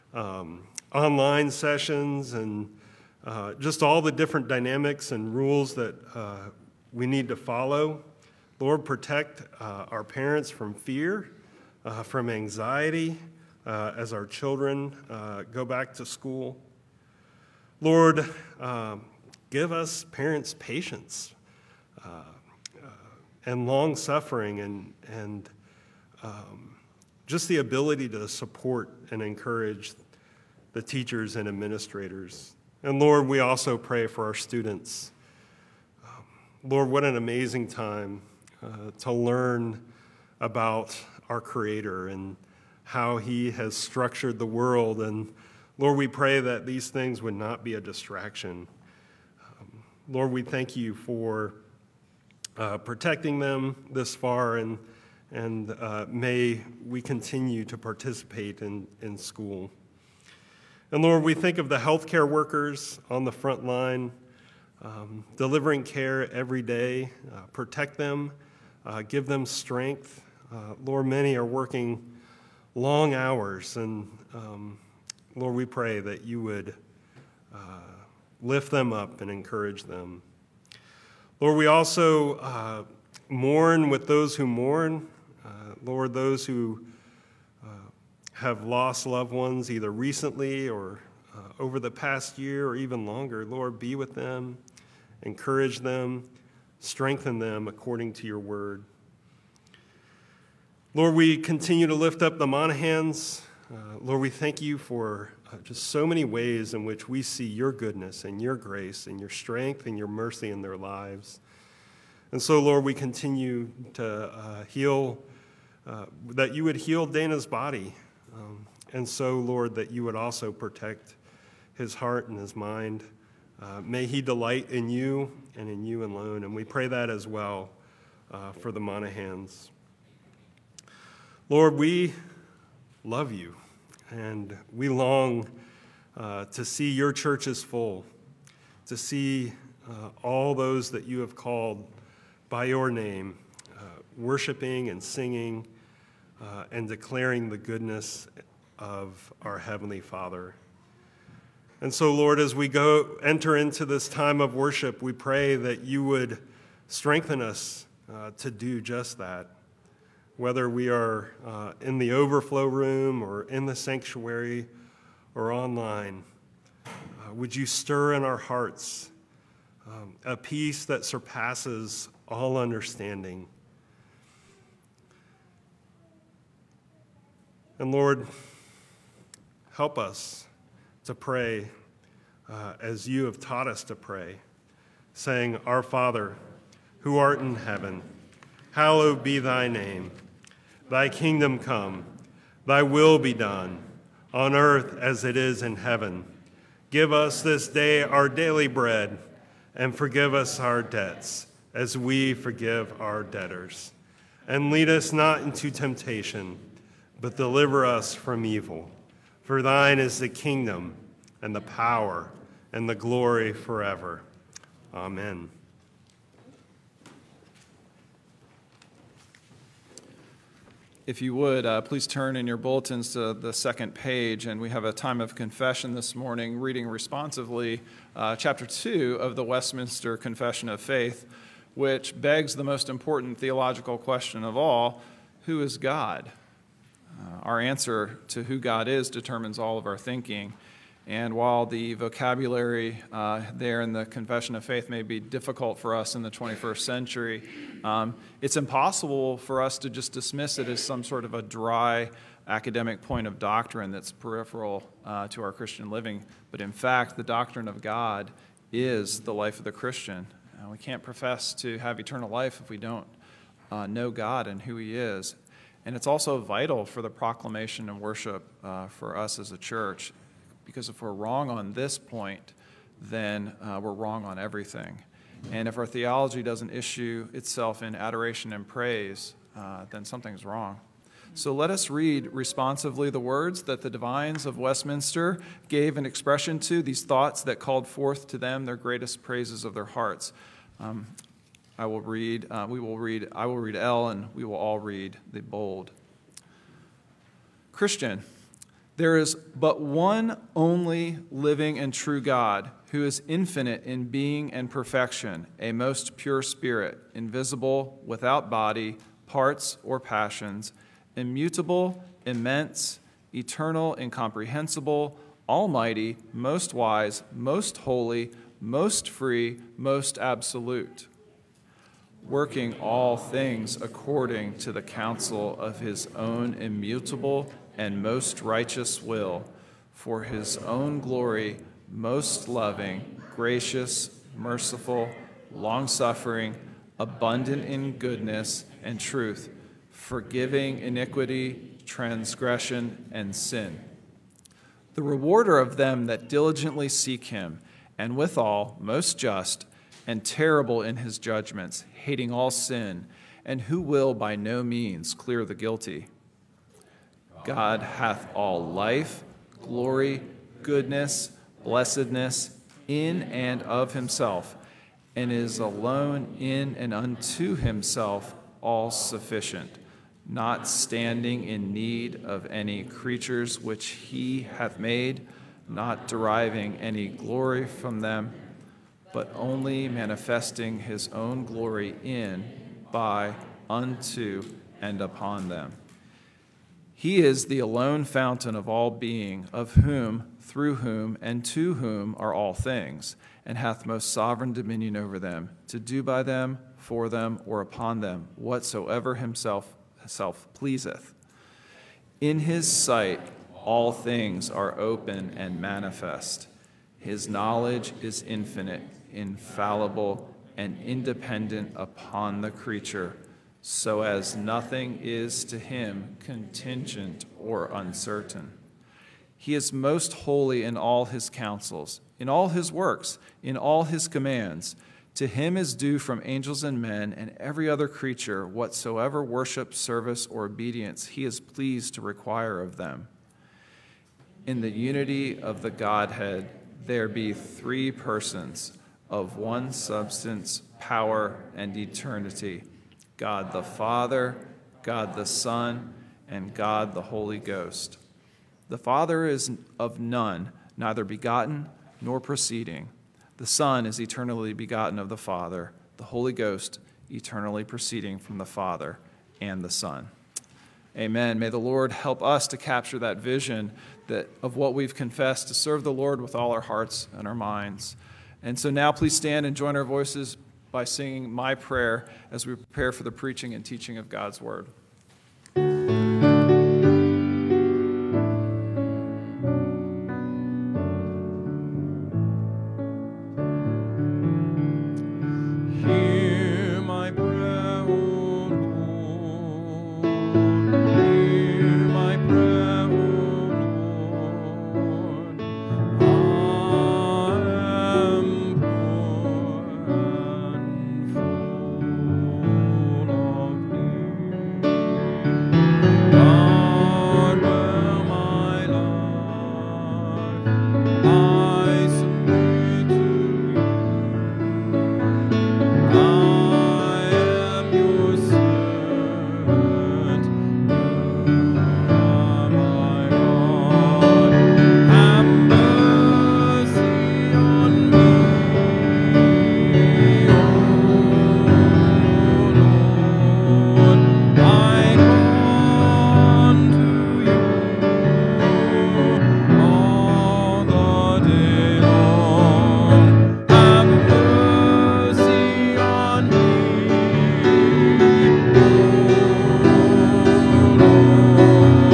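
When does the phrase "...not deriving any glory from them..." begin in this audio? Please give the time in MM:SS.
06:15.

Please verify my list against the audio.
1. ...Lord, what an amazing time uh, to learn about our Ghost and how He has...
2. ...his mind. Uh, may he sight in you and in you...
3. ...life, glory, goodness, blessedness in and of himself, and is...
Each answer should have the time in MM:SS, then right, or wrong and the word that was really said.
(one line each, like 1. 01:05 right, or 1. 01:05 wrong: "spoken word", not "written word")
1. 00:36 wrong: "Creator", not "Ghost"
2. 02:02 wrong: "delight", not "sight"
3. 05:58 right.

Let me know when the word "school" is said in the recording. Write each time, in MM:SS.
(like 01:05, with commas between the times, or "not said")
00:16, 00:59.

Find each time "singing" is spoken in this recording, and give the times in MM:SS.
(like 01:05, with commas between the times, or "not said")
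02:25, 07:50.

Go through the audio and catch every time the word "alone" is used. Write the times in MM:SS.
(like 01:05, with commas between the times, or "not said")
02:06, 06:05, 06:27.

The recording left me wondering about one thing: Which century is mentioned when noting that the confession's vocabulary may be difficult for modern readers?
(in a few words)
21st century.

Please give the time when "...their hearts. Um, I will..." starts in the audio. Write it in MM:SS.
04:49.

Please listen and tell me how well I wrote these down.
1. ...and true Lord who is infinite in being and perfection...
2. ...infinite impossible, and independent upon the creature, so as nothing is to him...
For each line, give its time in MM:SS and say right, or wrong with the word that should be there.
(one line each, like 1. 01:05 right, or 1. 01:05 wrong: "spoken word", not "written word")
1. 05:01 wrong: "God", not "Lord"
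2. 06:48 wrong: "infallible", not "impossible".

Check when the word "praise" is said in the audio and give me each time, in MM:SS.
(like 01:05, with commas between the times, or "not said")
04:38, 04:49.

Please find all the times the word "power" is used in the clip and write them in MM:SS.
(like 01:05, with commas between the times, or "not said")
03:31, 07:20.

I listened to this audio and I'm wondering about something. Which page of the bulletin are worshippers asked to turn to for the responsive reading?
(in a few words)
Second page.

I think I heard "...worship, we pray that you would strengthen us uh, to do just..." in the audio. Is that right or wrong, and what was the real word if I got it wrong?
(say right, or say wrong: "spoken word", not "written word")
right.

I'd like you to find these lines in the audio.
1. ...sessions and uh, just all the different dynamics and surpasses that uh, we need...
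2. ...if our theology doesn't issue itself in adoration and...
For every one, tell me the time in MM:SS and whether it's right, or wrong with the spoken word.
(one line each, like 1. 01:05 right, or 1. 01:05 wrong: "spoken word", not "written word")
1. 00:01 wrong: "rules", not "surpasses"
2. 04:35 right.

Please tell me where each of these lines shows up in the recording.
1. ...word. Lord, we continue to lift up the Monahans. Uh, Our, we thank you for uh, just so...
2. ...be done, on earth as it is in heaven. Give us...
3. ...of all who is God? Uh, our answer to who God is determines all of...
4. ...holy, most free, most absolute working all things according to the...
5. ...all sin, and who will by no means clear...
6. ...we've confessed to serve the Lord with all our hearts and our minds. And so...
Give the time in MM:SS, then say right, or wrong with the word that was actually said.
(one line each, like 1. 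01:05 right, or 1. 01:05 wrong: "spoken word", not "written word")
1. 01:38 wrong: "Lord", not "Our"
2. 03:13 right
3. 03:54 right
4. 05:17 right
5. 05:52 right
6. 07:44 right.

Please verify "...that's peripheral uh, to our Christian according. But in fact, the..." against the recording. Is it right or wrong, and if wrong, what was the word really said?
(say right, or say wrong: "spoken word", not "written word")
wrong: "living", not "according".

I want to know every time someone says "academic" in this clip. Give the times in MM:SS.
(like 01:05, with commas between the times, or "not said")
04:12.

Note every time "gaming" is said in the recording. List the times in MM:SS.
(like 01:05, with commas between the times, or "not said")
not said.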